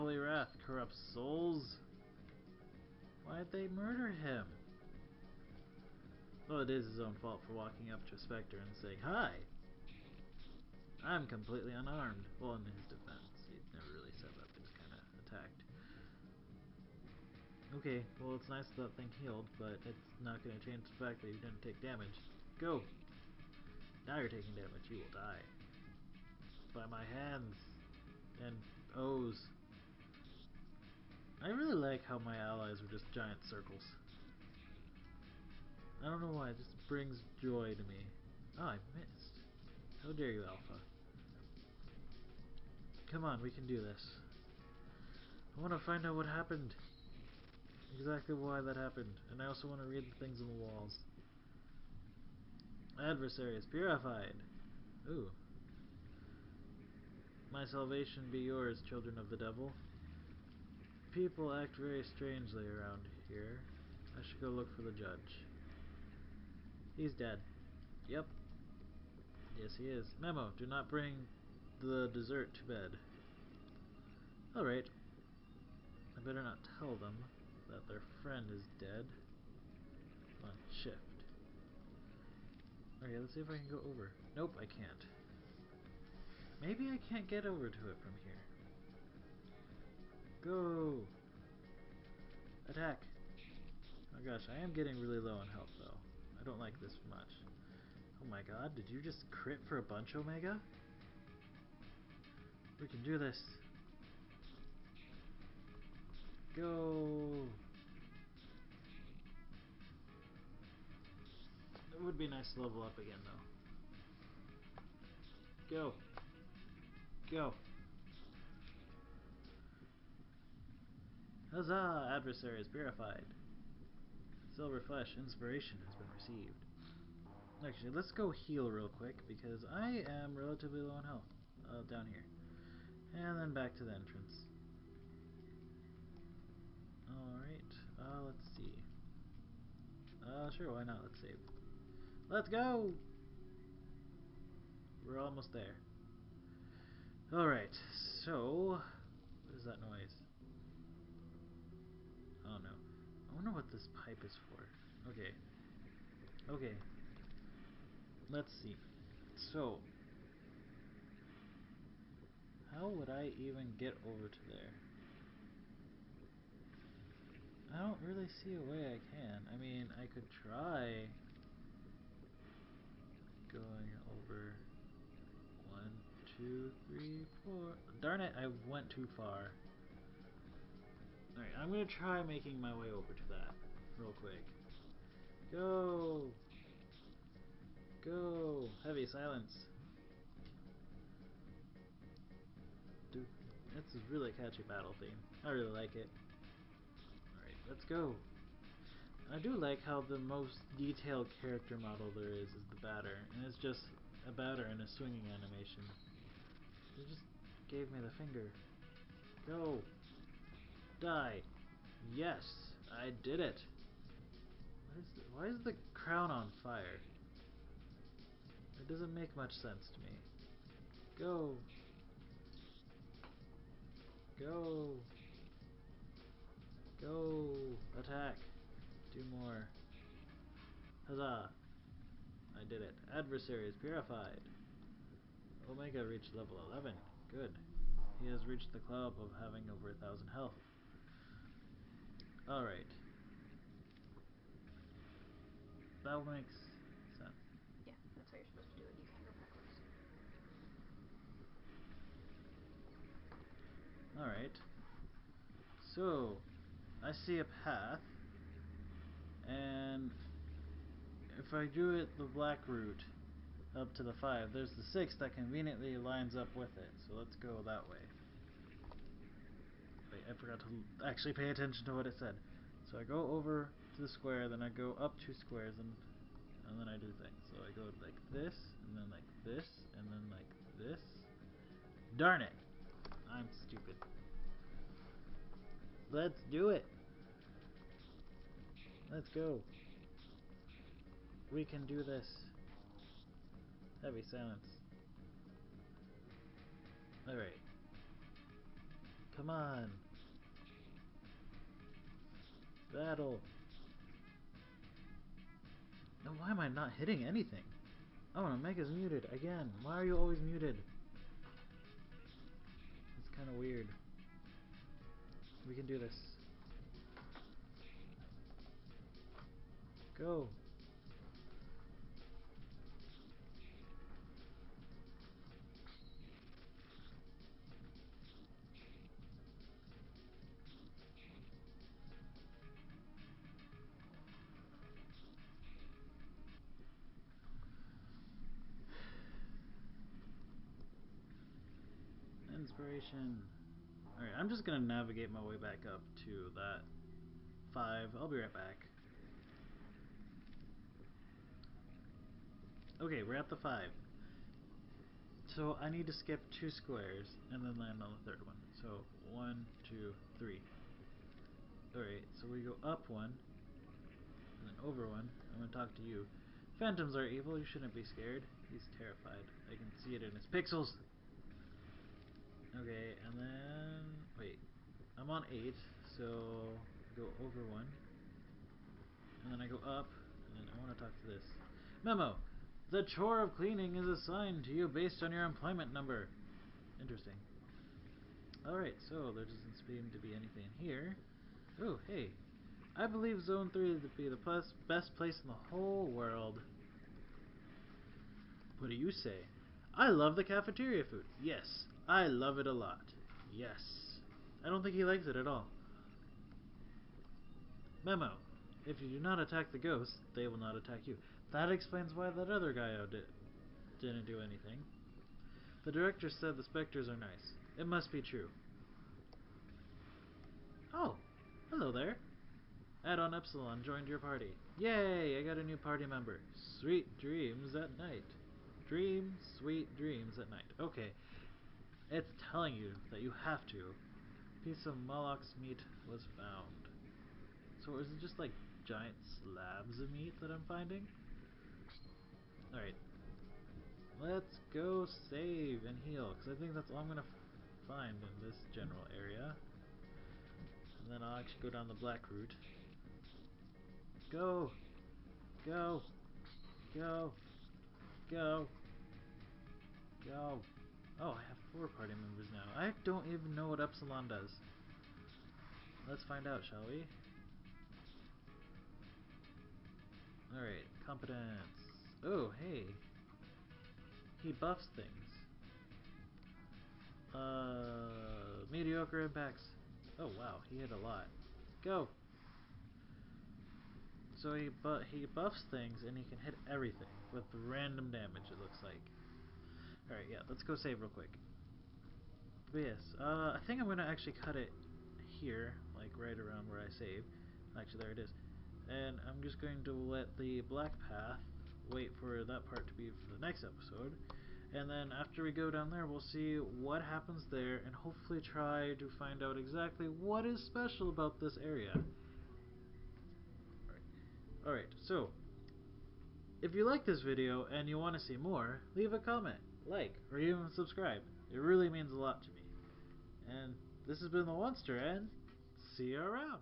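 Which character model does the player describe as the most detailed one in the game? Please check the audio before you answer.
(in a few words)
The batter.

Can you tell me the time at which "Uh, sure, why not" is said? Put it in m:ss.
2:20.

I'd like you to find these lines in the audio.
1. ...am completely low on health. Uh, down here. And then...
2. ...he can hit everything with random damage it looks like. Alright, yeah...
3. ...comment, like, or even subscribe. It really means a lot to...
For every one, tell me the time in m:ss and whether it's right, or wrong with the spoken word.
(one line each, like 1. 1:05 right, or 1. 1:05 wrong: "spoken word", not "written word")
1. 2:10 wrong: "relatively", not "completely"
2. 8:06 right
3. 8:39 right.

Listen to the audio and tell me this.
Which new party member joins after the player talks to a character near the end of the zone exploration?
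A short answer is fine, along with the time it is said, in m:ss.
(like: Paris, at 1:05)
Add-on Epsilon, at 7:03.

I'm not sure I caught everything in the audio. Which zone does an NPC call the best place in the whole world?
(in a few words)
Zone 3.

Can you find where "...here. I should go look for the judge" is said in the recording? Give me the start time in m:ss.
1:03.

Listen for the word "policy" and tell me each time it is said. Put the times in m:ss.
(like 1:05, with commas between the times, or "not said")
not said.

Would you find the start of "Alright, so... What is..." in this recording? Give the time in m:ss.
2:27.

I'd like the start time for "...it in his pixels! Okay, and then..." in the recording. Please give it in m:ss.
6:10.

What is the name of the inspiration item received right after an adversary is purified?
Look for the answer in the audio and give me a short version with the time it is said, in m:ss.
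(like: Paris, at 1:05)
Silver Flesh, at 2:04.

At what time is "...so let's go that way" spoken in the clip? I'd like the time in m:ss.
4:27.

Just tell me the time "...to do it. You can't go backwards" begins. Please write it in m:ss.
4:08.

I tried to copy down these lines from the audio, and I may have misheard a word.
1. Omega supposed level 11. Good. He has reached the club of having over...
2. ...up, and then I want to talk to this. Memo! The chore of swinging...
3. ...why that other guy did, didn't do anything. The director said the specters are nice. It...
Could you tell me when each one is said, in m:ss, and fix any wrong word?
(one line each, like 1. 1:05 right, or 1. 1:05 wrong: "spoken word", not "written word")
1. 3:55 wrong: "reached", not "supposed"
2. 6:19 wrong: "cleaning", not "swinging"
3. 6:52 right.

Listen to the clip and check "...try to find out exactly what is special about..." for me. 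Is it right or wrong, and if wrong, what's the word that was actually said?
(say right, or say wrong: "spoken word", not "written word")
right.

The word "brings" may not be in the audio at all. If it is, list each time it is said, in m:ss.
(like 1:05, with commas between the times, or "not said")
0:36, 1:10.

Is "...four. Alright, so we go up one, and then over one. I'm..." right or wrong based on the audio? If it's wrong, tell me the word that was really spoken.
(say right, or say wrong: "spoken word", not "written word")
wrong: "three", not "four".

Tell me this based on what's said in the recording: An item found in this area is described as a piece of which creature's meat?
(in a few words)
Moloch.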